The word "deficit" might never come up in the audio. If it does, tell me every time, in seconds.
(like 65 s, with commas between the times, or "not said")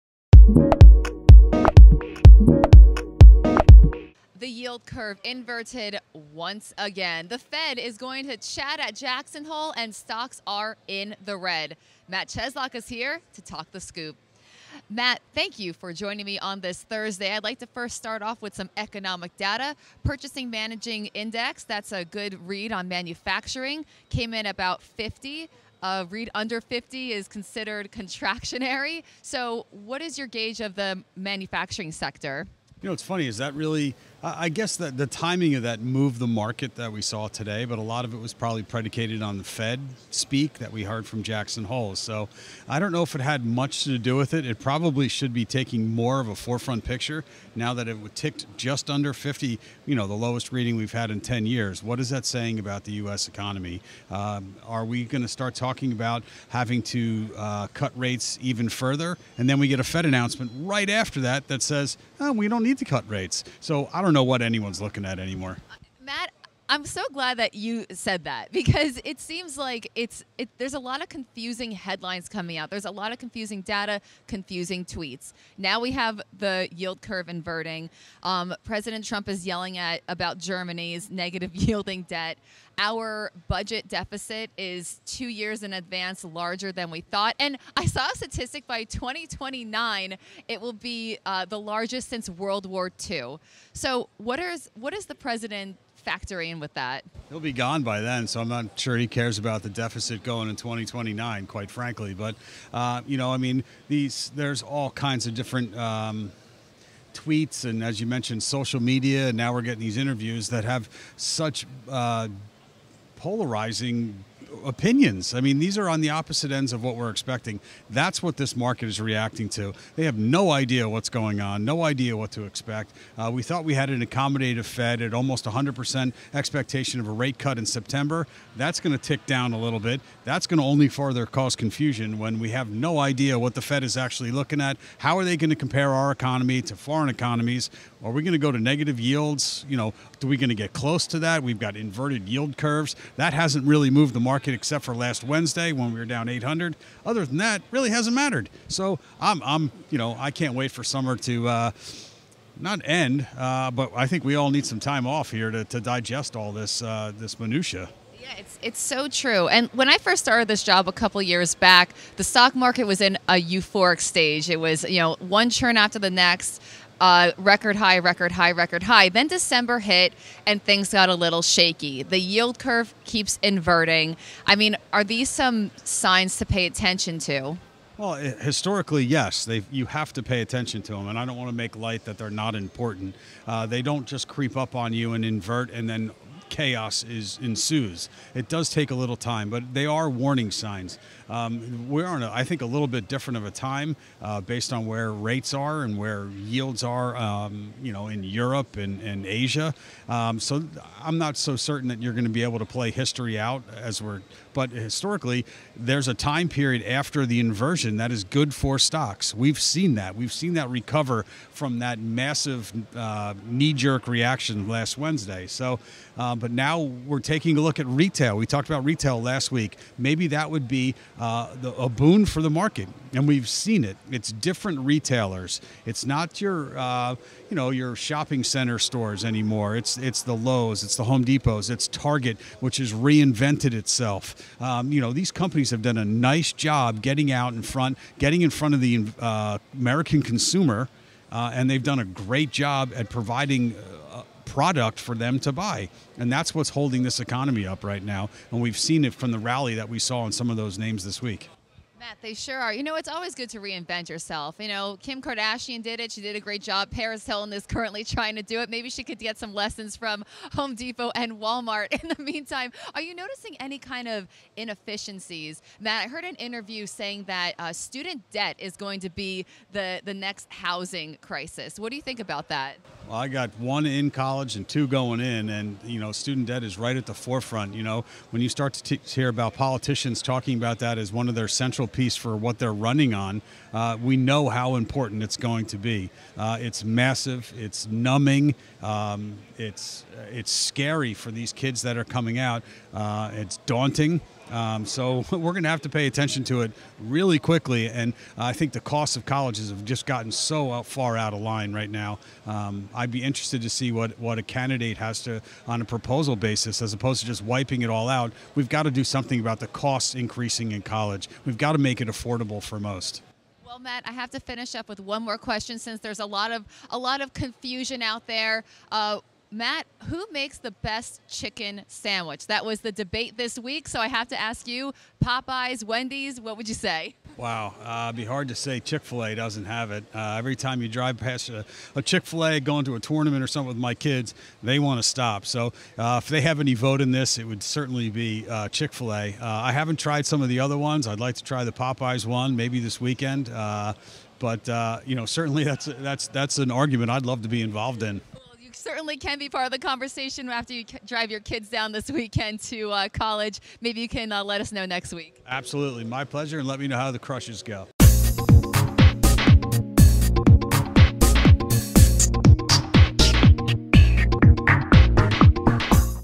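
83 s, 99 s.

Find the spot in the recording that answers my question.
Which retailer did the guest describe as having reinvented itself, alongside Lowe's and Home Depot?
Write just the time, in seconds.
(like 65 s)
231 s.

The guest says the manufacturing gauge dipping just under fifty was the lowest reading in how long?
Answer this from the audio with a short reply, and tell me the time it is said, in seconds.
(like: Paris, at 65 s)
10 years, at 51 s.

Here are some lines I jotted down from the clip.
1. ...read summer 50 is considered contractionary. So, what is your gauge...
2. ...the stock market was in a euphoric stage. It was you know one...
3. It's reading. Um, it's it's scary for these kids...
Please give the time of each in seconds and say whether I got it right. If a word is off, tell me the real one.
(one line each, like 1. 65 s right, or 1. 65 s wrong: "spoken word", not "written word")
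1. 26 s wrong: "under", not "summer"
2. 162 s right
3. 287 s wrong: "numbing", not "reading".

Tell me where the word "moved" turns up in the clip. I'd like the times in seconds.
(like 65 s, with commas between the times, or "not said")
35 s, 143 s.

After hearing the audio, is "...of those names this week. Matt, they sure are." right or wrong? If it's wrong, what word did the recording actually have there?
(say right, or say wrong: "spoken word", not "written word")
right.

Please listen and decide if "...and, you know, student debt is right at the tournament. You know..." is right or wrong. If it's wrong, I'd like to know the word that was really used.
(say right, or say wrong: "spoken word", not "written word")
wrong: "forefront", not "tournament".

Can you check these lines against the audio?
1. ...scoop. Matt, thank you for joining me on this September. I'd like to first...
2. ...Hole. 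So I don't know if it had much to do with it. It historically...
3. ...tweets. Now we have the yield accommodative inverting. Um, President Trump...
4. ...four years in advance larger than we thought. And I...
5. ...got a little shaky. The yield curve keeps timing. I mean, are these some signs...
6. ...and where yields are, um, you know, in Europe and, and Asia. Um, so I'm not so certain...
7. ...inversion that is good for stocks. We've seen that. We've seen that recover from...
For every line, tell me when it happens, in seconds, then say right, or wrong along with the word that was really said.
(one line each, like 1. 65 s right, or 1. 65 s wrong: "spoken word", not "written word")
1. 13 s wrong: "Thursday", not "September"
2. 41 s wrong: "probably", not "historically"
3. 74 s wrong: "curve", not "accommodative"
4. 85 s wrong: "two", not "four"
5. 170 s wrong: "inverting", not "timing"
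6. 195 s right
7. 207 s right.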